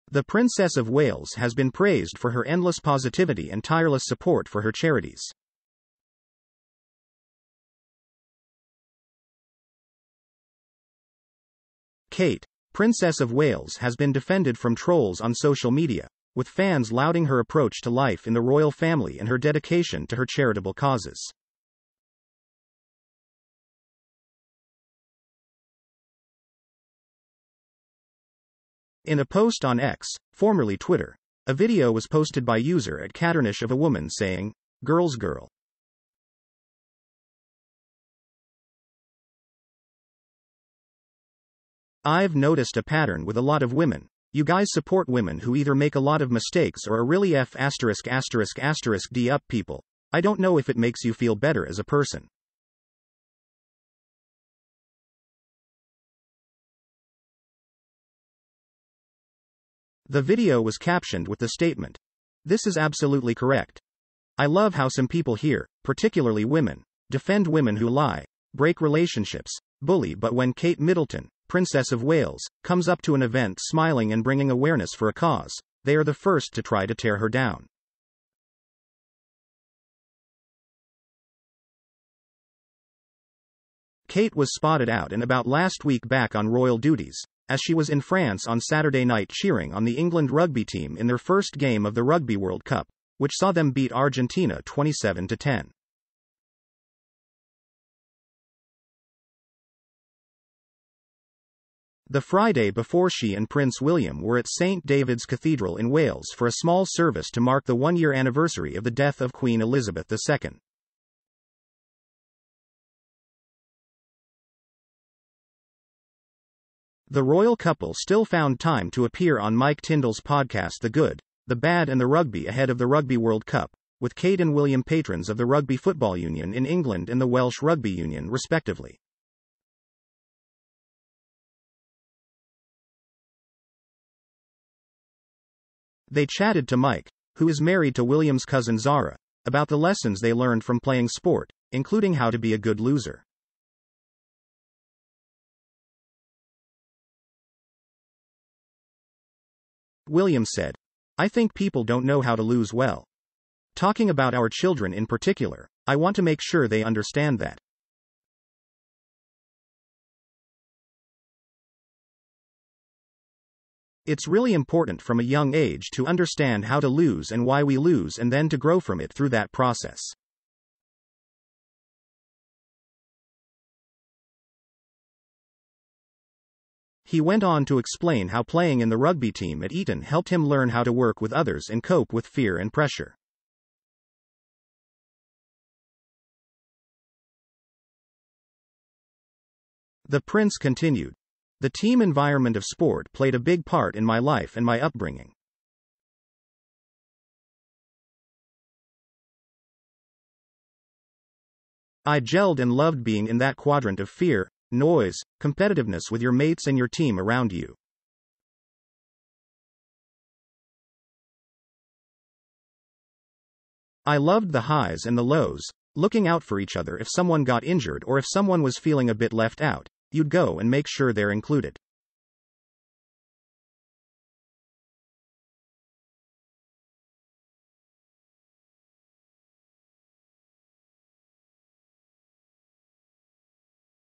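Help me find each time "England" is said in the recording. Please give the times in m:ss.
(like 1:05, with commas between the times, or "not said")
1:29, 2:06.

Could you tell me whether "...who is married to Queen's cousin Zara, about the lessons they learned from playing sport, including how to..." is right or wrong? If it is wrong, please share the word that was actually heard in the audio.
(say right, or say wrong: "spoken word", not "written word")
wrong: "William", not "Queen".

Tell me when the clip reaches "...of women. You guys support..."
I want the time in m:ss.
0:43.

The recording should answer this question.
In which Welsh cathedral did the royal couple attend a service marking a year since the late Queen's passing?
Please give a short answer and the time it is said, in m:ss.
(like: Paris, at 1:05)
St. David's Cathedral, at 1:44.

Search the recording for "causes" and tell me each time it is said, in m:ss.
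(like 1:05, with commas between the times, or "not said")
0:20, 1:15.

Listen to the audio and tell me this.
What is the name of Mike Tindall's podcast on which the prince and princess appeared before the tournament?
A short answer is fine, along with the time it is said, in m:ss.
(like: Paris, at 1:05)
The Good, the Bad and the Rugby, at 2:00.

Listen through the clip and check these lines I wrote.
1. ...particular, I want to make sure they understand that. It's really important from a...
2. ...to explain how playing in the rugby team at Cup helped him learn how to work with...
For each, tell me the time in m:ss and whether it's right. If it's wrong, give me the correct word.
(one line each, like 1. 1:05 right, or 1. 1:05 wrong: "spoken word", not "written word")
1. 2:35 right
2. 2:57 wrong: "Eton", not "Cup".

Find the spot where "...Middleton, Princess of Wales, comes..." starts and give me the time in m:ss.
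1:10.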